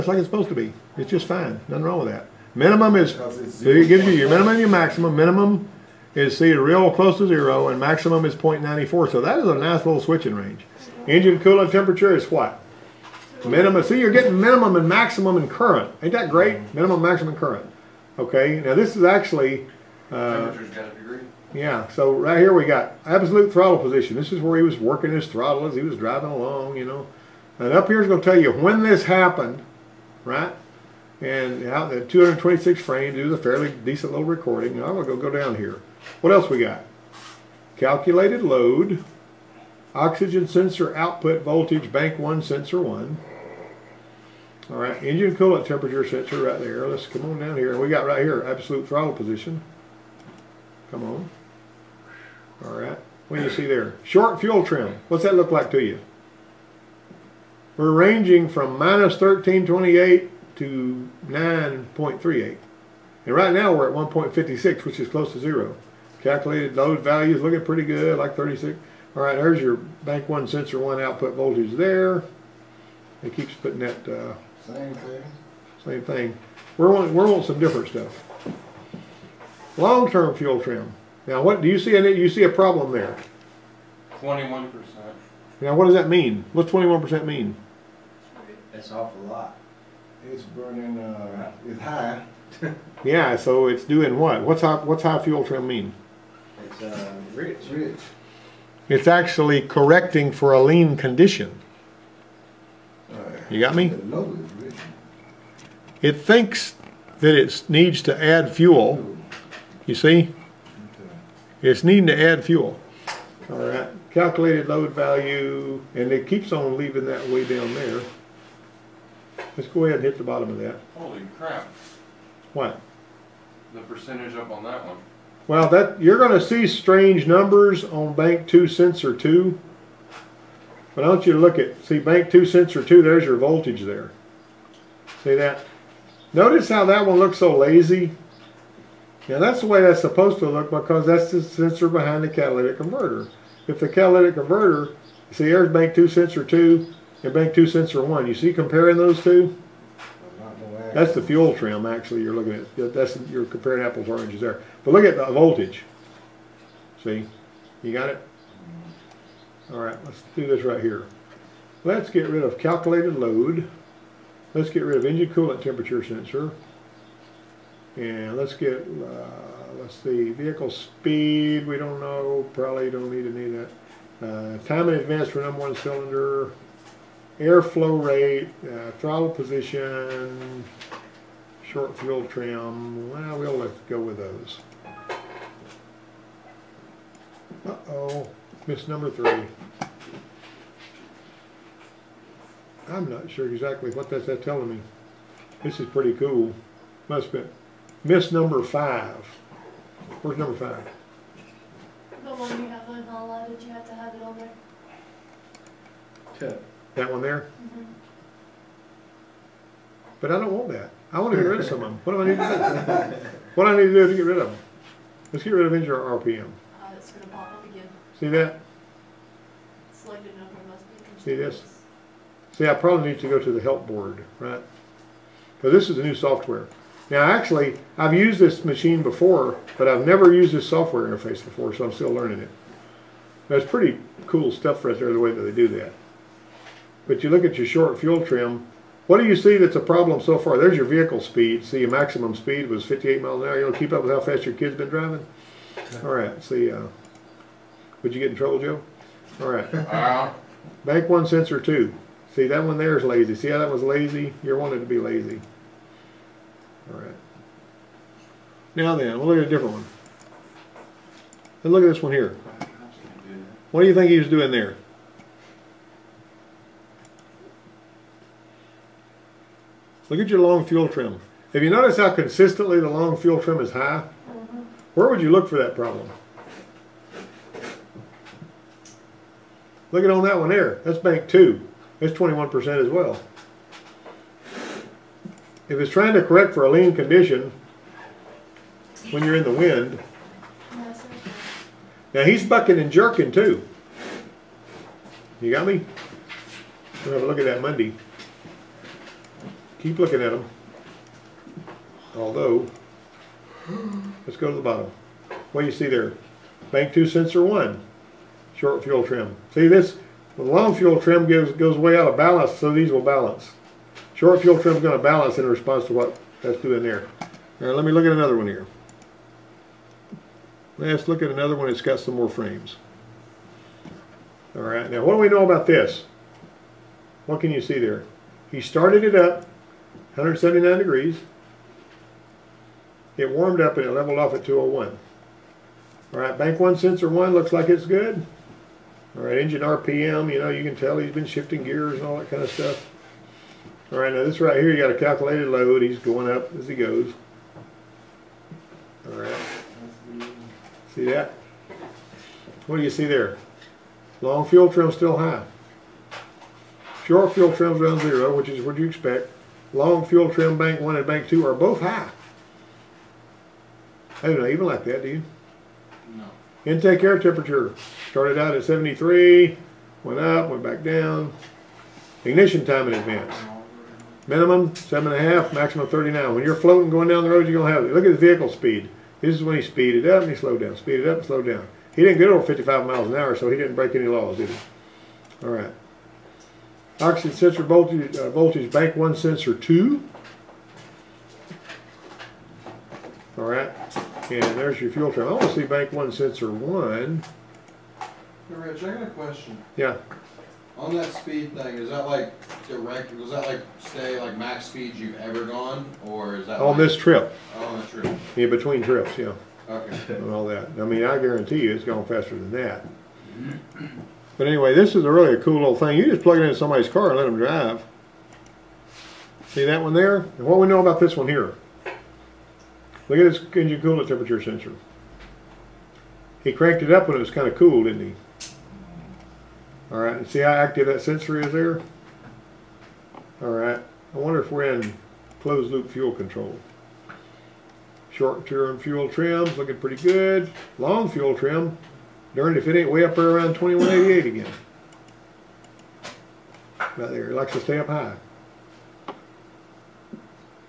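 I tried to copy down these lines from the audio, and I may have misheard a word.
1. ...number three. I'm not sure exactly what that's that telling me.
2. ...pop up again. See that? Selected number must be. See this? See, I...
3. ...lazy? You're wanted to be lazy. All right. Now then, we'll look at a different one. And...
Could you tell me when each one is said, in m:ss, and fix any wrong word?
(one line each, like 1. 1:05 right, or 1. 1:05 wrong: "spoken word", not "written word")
1. 3:08 right
2. 3:37 right
3. 4:13 right.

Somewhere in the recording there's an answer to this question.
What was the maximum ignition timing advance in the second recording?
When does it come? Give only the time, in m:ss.
6:15.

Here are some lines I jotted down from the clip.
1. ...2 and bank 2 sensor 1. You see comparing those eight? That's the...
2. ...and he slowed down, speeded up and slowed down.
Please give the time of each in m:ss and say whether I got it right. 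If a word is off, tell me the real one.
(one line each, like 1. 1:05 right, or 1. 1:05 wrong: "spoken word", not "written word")
1. 2:26 wrong: "two", not "eight"
2. 6:20 right.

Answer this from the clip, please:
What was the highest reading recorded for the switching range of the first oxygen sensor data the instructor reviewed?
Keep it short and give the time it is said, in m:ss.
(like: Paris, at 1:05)
0.94, at 0:08.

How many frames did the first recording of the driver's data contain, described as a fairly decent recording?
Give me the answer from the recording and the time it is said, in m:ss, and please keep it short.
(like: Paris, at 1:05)
226, at 0:32.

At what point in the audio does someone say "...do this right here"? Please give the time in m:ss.
2:40.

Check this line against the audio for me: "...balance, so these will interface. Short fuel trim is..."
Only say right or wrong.
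wrong.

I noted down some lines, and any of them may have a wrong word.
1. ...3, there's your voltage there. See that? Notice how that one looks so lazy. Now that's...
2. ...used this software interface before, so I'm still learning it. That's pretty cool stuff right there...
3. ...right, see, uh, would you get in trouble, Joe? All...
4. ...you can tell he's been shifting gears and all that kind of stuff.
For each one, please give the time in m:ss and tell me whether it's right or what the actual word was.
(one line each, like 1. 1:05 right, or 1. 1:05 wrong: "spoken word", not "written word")
1. 2:12 wrong: "2", not "3"
2. 3:50 right
3. 4:06 right
4. 5:40 right.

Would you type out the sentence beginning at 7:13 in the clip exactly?
All right, I wonder if we're in closed loop fuel control.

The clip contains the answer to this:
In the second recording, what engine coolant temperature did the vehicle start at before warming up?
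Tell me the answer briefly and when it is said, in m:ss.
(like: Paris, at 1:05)
179 degrees, at 5:30.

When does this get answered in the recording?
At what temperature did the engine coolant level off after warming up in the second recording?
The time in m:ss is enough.
5:34.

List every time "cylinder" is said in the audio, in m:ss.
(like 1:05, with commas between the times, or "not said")
2:55.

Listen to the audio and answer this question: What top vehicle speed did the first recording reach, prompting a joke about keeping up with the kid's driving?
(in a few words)
58 mph.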